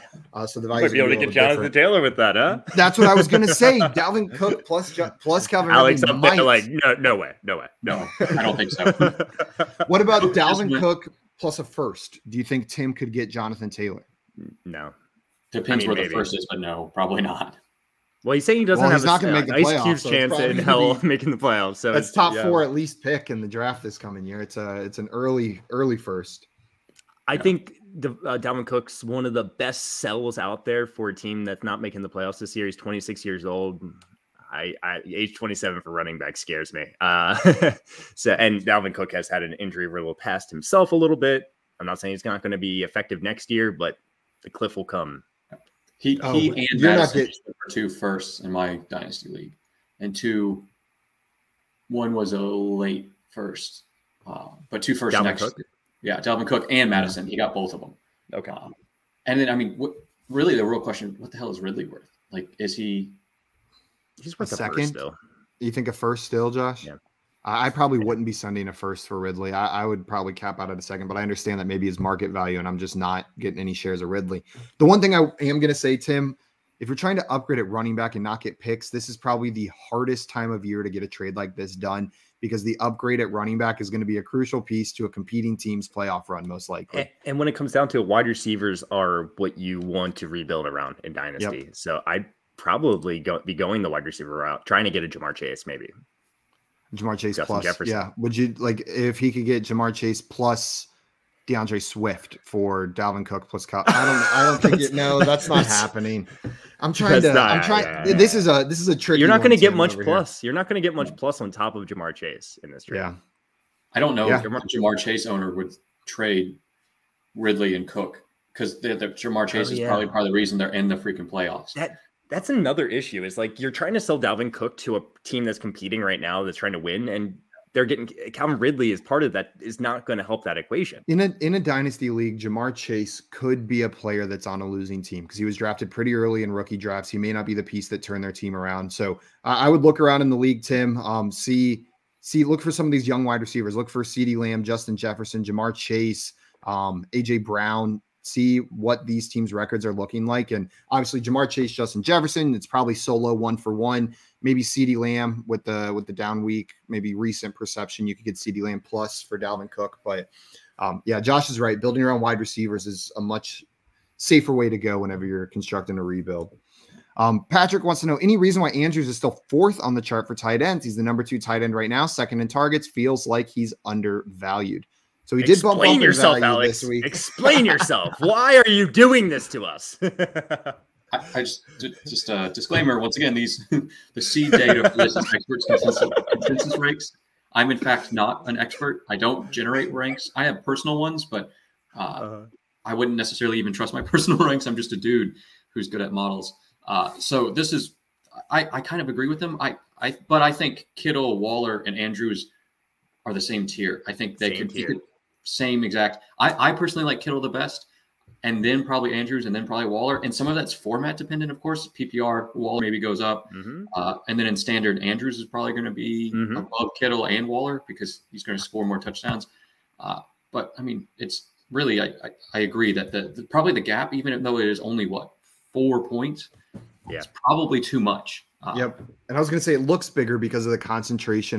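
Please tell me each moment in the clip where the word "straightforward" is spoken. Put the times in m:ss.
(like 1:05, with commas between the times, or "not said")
not said.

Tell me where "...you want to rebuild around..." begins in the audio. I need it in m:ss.
1:29.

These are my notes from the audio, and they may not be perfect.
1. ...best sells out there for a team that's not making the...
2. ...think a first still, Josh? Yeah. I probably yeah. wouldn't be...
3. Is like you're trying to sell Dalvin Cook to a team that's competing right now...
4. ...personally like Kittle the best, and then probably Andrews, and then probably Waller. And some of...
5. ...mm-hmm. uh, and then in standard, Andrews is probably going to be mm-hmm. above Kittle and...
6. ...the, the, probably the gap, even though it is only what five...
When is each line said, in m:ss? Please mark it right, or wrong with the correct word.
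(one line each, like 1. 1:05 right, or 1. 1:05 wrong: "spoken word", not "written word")
1. 0:29 right
2. 1:05 right
3. 2:03 right
4. 3:26 right
5. 3:33 right
6. 3:43 wrong: "four", not "five".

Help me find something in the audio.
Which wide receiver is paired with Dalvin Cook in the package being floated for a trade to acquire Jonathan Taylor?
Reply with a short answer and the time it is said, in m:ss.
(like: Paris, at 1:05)
Calvin Ridley, at 0:04.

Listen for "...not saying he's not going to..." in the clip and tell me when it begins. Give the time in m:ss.
0:41.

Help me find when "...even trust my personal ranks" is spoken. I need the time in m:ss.
3:13.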